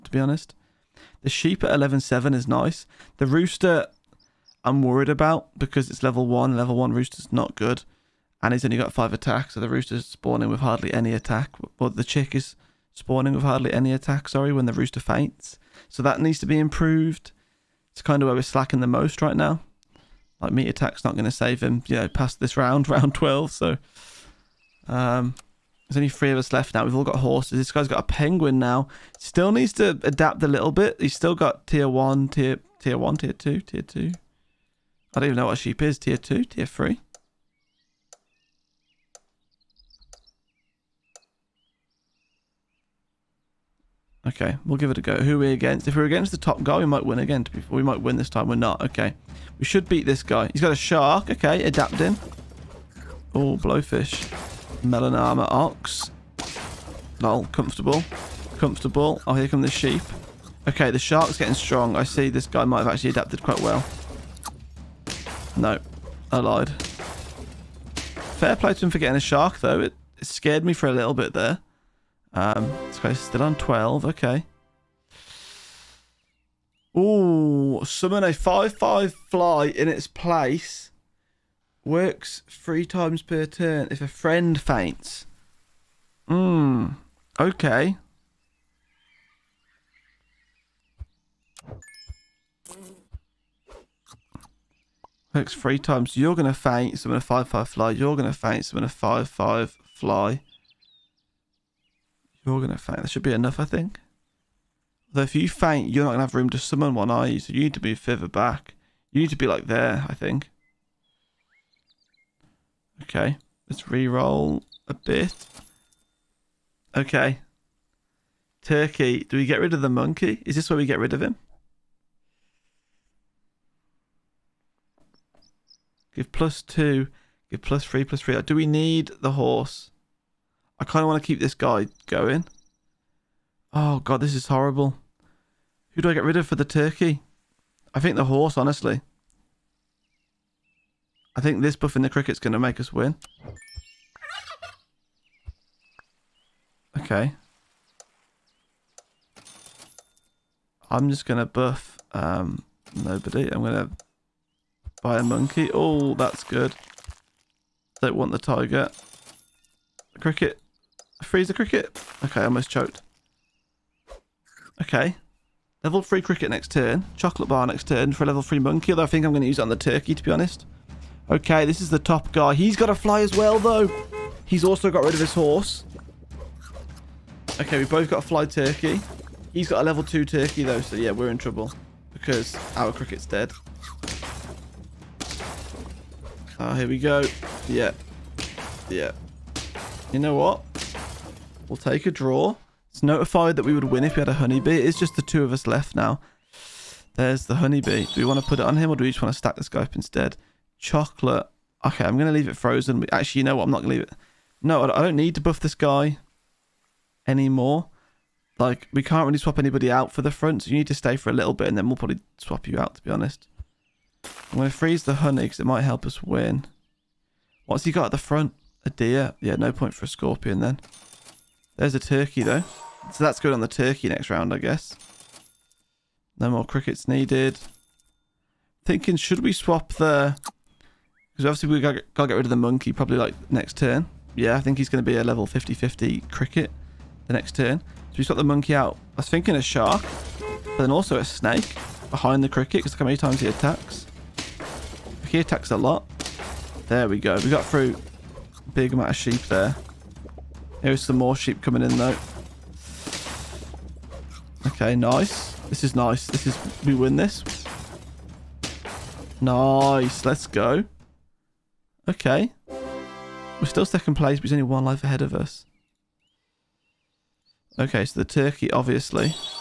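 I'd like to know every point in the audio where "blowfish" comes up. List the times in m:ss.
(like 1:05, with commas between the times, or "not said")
0:53.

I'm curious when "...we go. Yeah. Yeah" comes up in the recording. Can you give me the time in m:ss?
3:06.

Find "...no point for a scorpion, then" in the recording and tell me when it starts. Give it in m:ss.
3:39.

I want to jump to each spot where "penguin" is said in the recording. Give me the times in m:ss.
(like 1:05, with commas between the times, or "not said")
0:28.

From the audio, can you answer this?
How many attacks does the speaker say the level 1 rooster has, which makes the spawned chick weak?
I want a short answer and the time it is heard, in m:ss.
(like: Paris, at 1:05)
5, at 0:08.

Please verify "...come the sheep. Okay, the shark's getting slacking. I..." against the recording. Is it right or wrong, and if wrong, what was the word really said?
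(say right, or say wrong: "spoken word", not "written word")
wrong: "strong", not "slacking".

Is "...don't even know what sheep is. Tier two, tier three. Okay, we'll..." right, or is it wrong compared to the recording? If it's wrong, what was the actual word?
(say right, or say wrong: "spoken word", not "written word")
right.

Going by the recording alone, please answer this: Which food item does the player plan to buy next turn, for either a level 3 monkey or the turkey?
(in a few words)
Chocolate bar.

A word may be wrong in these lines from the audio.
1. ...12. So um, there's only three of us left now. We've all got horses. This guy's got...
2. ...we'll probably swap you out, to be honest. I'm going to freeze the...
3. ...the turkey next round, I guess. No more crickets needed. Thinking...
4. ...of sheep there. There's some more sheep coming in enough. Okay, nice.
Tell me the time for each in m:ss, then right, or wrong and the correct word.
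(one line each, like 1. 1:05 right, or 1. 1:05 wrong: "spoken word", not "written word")
1. 0:23 right
2. 3:31 right
3. 3:43 right
4. 4:09 wrong: "though", not "enough".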